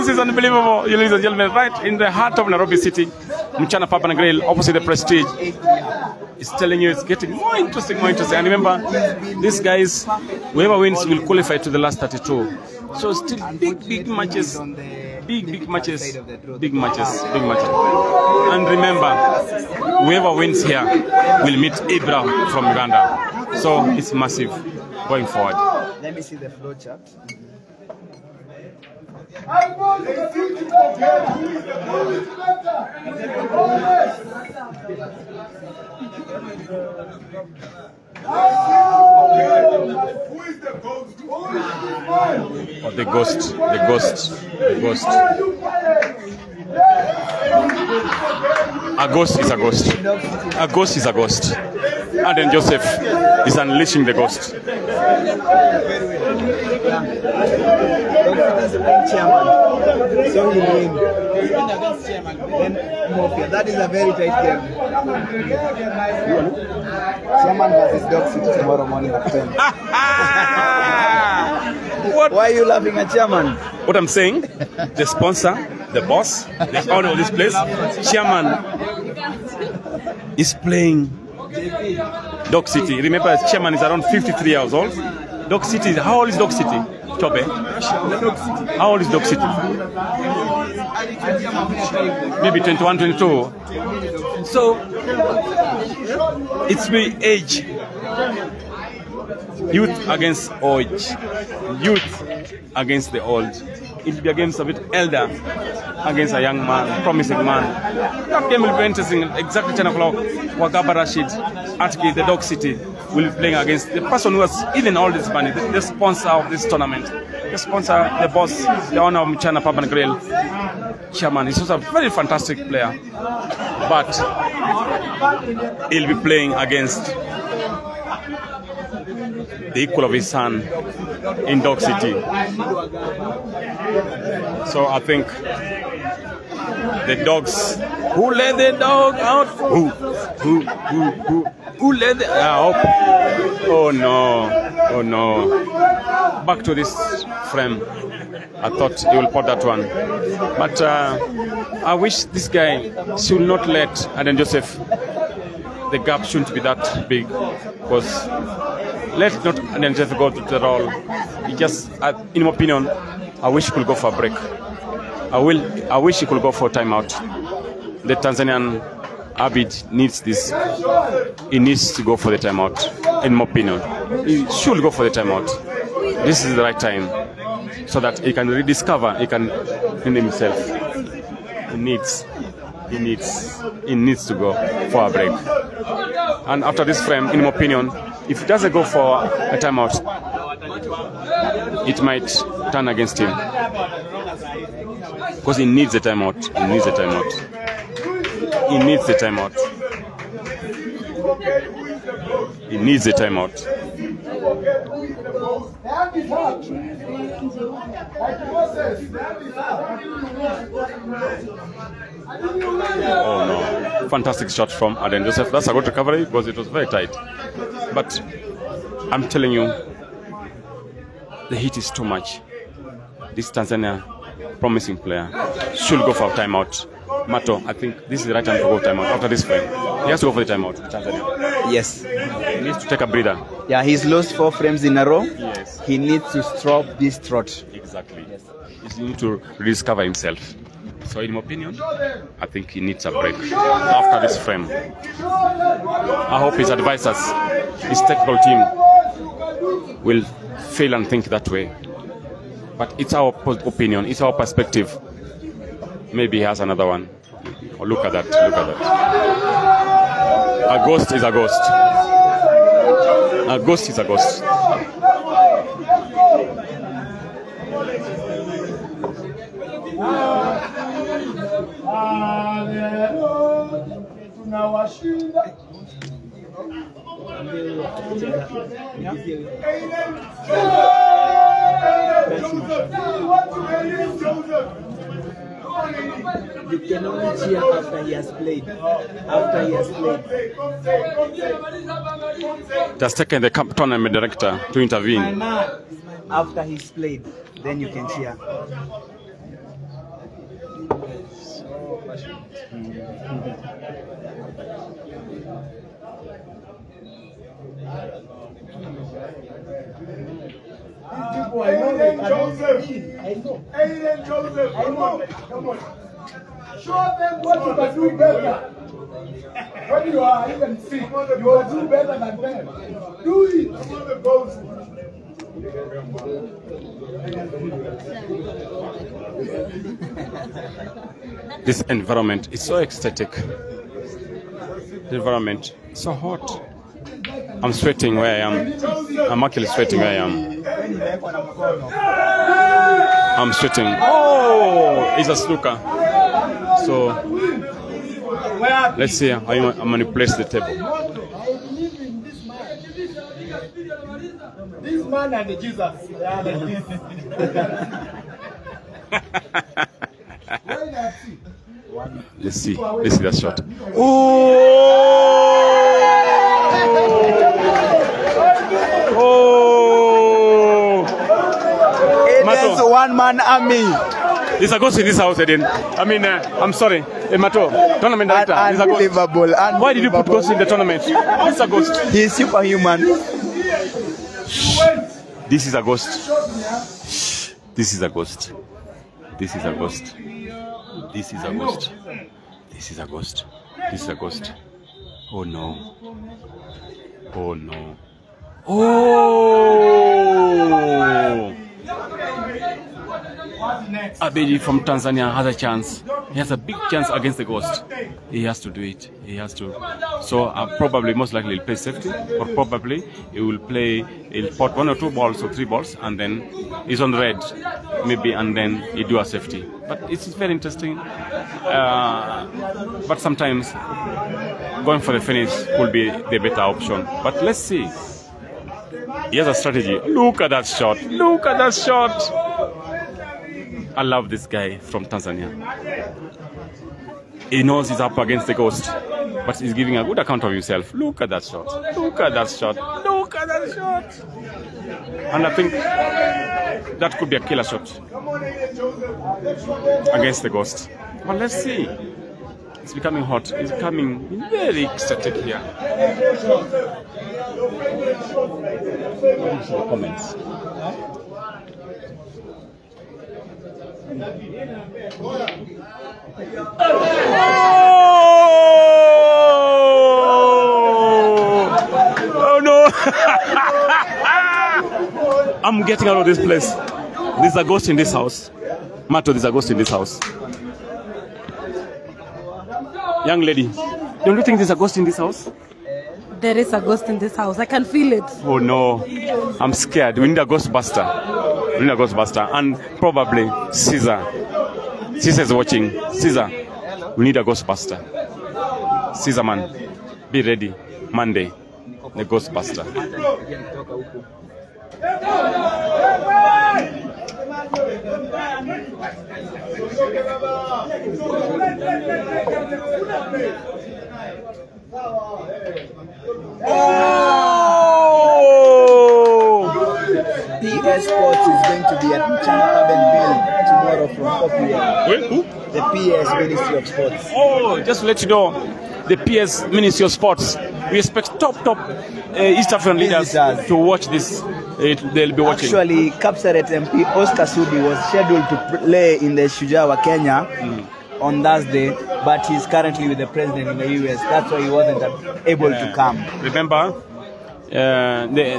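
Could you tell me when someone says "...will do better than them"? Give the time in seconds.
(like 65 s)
321 s.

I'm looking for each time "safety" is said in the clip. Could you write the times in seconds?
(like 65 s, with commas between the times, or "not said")
411 s, 419 s.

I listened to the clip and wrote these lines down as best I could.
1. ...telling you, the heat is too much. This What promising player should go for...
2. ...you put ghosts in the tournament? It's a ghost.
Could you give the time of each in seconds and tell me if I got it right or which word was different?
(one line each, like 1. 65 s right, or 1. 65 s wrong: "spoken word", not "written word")
1. 219 s wrong: "Tanzania", not "What"
2. 380 s right.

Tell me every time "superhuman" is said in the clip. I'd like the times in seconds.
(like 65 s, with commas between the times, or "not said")
382 s.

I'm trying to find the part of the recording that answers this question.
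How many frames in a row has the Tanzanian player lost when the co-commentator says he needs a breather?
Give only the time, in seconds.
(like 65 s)
234 s.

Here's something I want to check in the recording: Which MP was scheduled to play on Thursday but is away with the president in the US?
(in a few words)
Oscar Sudi.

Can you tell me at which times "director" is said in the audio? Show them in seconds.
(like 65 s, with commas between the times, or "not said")
294 s, 378 s.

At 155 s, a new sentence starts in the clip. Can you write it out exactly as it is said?
The gap shouldn't be that big, because let's not identify God at all.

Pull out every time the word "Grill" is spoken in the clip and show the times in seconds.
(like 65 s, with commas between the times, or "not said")
4 s, 119 s.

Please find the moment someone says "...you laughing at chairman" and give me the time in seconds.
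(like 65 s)
72 s.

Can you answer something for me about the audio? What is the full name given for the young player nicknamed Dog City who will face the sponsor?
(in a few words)
Wagaba Rashid.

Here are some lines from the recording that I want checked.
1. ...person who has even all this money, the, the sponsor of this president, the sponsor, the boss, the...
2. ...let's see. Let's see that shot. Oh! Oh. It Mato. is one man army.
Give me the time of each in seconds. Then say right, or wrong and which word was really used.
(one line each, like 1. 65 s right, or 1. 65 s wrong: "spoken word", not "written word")
1. 114 s wrong: "tournament", not "president"
2. 362 s right.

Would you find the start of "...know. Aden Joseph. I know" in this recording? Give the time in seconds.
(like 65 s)
313 s.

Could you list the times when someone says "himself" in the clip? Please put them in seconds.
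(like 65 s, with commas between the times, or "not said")
180 s, 240 s, 440 s.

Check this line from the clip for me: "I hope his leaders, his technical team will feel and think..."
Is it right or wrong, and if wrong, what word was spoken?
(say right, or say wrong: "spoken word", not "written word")
wrong: "advisors", not "leaders".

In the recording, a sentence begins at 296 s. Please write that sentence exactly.
After he's played, then you can cheer.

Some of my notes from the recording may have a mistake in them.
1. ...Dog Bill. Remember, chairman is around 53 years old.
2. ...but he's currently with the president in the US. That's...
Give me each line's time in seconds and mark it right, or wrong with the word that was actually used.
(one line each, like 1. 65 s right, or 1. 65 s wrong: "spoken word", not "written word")
1. 82 s wrong: "City", not "Bill"
2. 542 s right.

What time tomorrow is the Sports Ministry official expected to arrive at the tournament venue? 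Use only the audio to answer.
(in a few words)
4 p.m.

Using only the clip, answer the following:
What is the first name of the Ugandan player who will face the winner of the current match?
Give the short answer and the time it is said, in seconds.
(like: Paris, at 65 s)
Abraham, at 21 s.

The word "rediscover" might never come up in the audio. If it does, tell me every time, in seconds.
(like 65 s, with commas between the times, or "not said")
178 s, 239 s.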